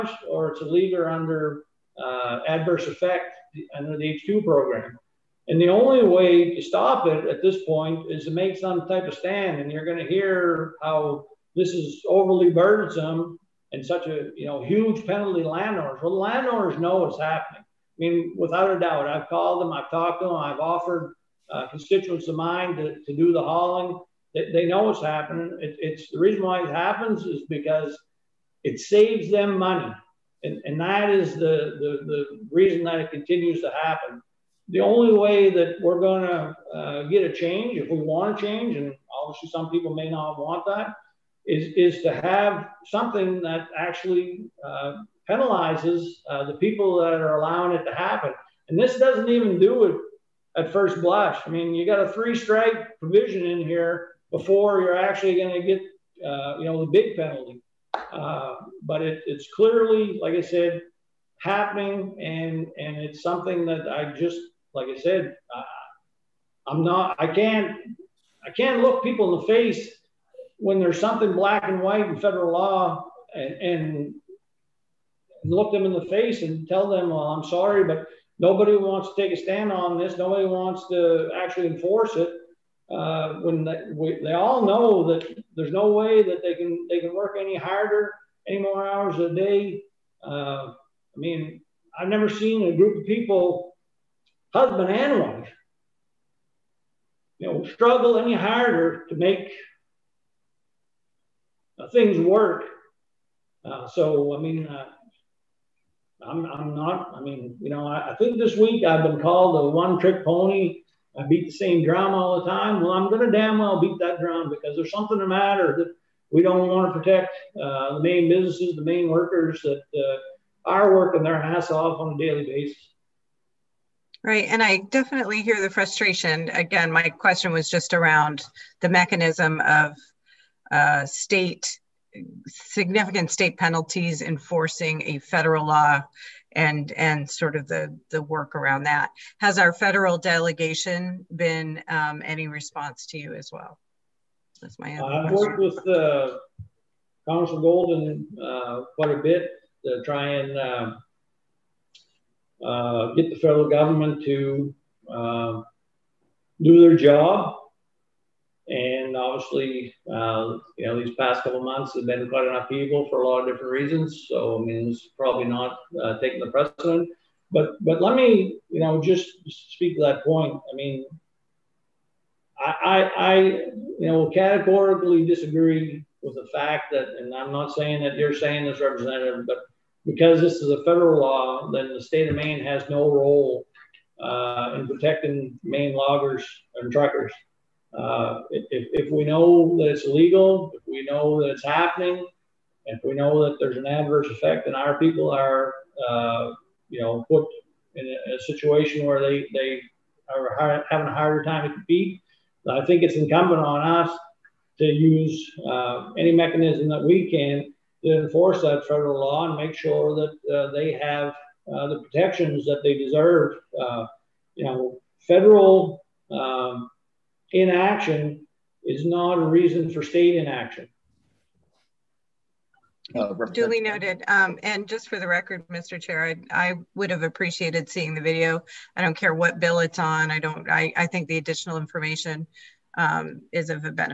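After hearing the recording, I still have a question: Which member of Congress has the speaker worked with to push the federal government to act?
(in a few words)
Congressman Golden.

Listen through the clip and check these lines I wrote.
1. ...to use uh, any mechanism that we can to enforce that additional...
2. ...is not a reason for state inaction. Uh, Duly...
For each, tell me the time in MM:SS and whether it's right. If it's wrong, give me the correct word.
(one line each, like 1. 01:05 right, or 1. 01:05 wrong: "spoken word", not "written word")
1. 03:24 wrong: "federal", not "additional"
2. 03:38 right.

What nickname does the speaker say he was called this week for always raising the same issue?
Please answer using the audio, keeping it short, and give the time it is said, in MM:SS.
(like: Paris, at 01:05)
one trick pony, at 01:49.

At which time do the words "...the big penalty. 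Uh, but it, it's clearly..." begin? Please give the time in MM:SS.
00:56.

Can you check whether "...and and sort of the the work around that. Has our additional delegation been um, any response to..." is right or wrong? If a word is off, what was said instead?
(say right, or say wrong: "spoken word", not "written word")
wrong: "federal", not "additional".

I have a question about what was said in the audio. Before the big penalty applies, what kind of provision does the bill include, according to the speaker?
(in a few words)
three strike provision.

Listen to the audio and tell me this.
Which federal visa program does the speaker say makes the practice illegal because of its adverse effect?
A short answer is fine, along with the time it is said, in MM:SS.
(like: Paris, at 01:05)
H2 program, at 00:04.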